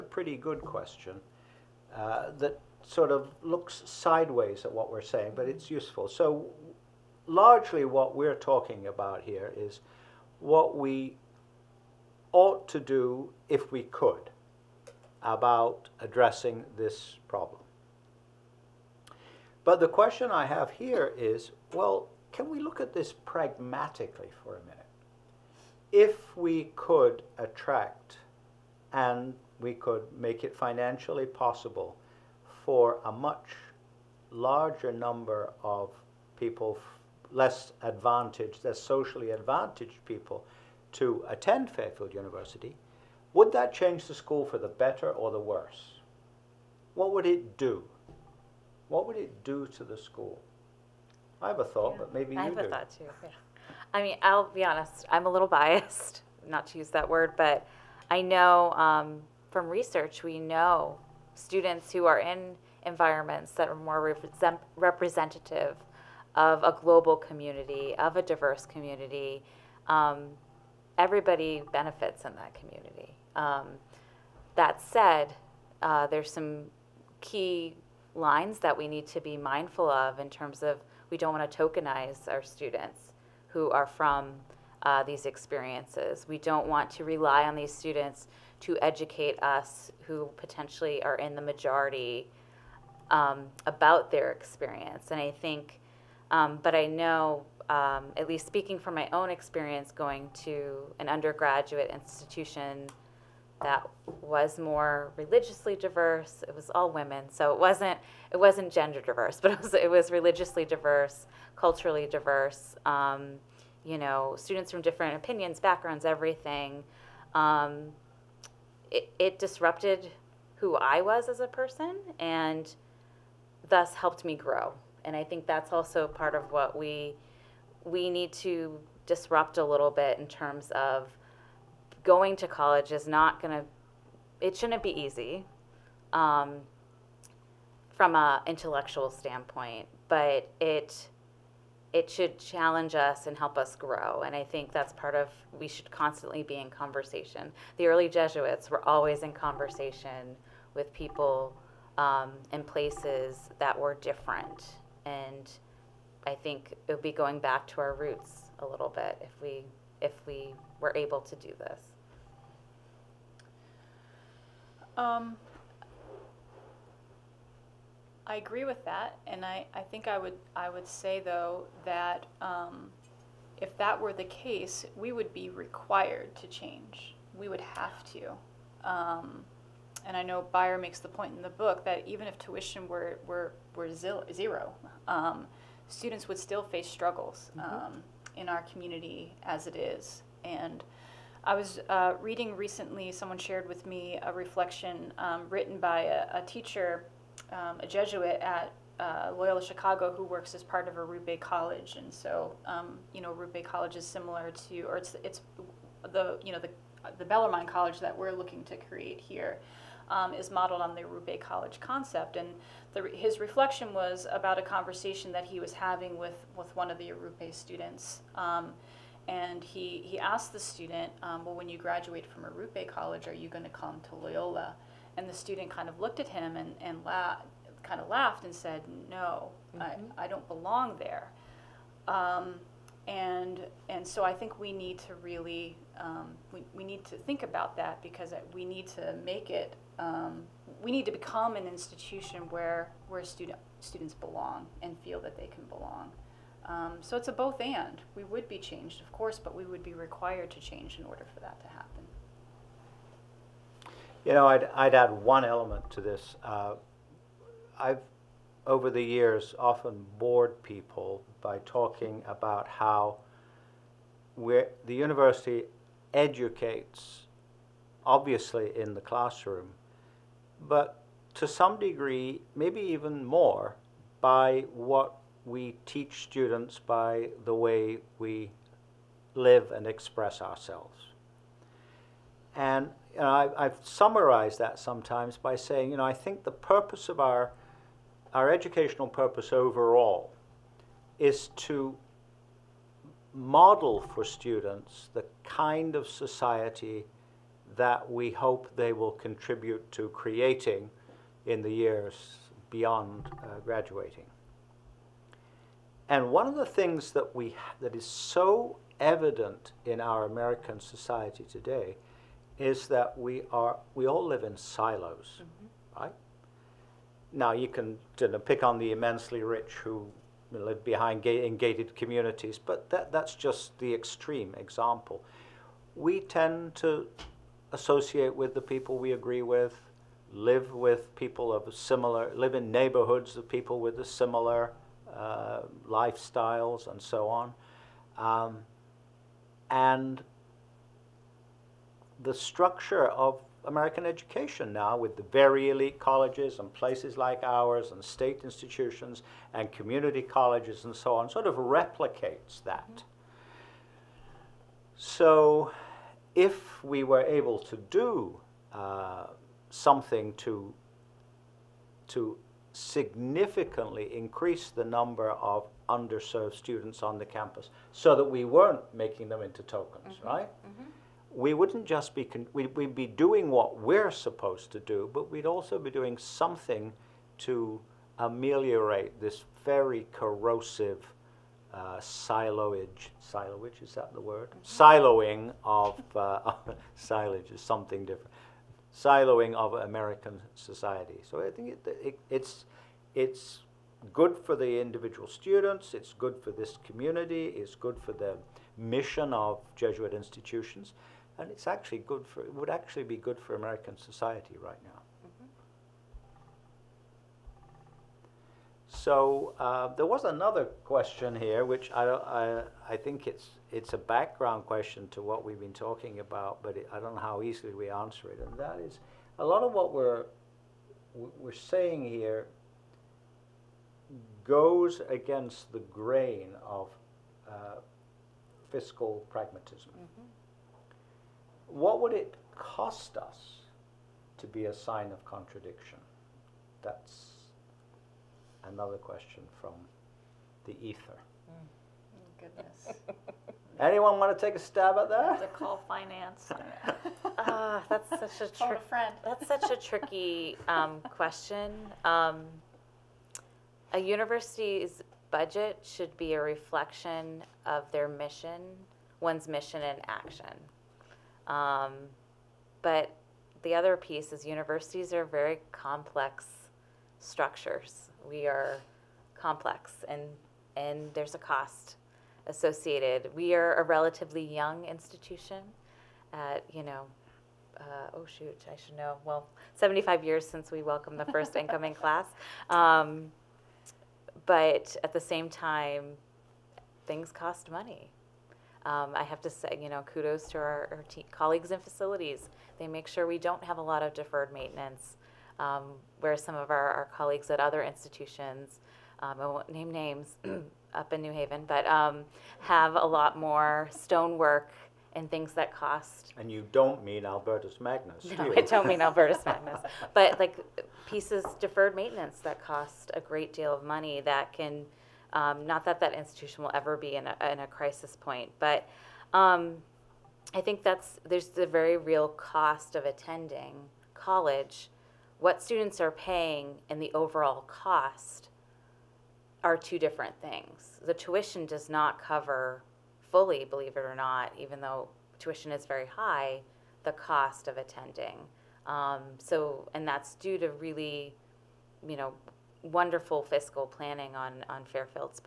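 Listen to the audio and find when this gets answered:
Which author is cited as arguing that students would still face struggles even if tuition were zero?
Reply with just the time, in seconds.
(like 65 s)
180 s.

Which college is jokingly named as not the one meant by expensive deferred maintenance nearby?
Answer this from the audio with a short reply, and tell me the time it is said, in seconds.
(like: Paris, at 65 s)
Albertus Magnus, at 507 s.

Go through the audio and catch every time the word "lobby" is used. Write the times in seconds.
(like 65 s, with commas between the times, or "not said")
not said.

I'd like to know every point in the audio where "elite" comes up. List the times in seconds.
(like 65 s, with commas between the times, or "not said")
345 s.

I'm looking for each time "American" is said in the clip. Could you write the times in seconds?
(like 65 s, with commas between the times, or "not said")
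310 s, 343 s, 389 s, 403 s.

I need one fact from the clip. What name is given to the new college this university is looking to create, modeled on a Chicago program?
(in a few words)
Bellarmine College.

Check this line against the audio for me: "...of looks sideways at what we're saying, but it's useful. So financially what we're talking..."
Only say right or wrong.
wrong.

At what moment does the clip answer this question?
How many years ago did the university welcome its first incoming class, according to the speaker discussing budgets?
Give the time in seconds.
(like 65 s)
479 s.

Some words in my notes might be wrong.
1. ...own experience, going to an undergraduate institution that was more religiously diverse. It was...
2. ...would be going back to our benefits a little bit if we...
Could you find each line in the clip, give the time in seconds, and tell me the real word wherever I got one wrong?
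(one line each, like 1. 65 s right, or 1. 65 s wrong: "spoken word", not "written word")
1. 99 s right
2. 156 s wrong: "roots", not "benefits".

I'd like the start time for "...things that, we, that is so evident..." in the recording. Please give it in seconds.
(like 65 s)
306 s.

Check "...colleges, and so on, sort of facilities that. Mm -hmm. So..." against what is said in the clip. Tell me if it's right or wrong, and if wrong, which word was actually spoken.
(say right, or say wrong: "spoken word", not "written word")
wrong: "replicates", not "facilities".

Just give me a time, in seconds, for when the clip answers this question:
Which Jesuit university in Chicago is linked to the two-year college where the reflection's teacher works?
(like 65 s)
199 s.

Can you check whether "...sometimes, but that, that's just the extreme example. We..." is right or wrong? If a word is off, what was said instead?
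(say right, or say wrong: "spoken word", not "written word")
wrong: "communities", not "sometimes".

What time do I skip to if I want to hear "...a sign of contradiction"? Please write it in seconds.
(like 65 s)
434 s.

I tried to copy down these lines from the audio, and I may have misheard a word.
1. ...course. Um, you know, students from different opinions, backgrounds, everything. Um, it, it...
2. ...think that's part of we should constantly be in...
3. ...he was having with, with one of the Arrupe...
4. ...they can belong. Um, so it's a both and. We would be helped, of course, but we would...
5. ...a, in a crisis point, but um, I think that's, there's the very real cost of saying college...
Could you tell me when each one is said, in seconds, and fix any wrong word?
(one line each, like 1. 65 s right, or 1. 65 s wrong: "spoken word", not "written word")
1. 112 s wrong: "diverse", not "course"
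2. 144 s right
3. 215 s right
4. 245 s wrong: "changed", not "helped"
5. 517 s wrong: "attending", not "saying".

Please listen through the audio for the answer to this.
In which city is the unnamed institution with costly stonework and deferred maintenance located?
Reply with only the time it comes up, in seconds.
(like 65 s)
501 s.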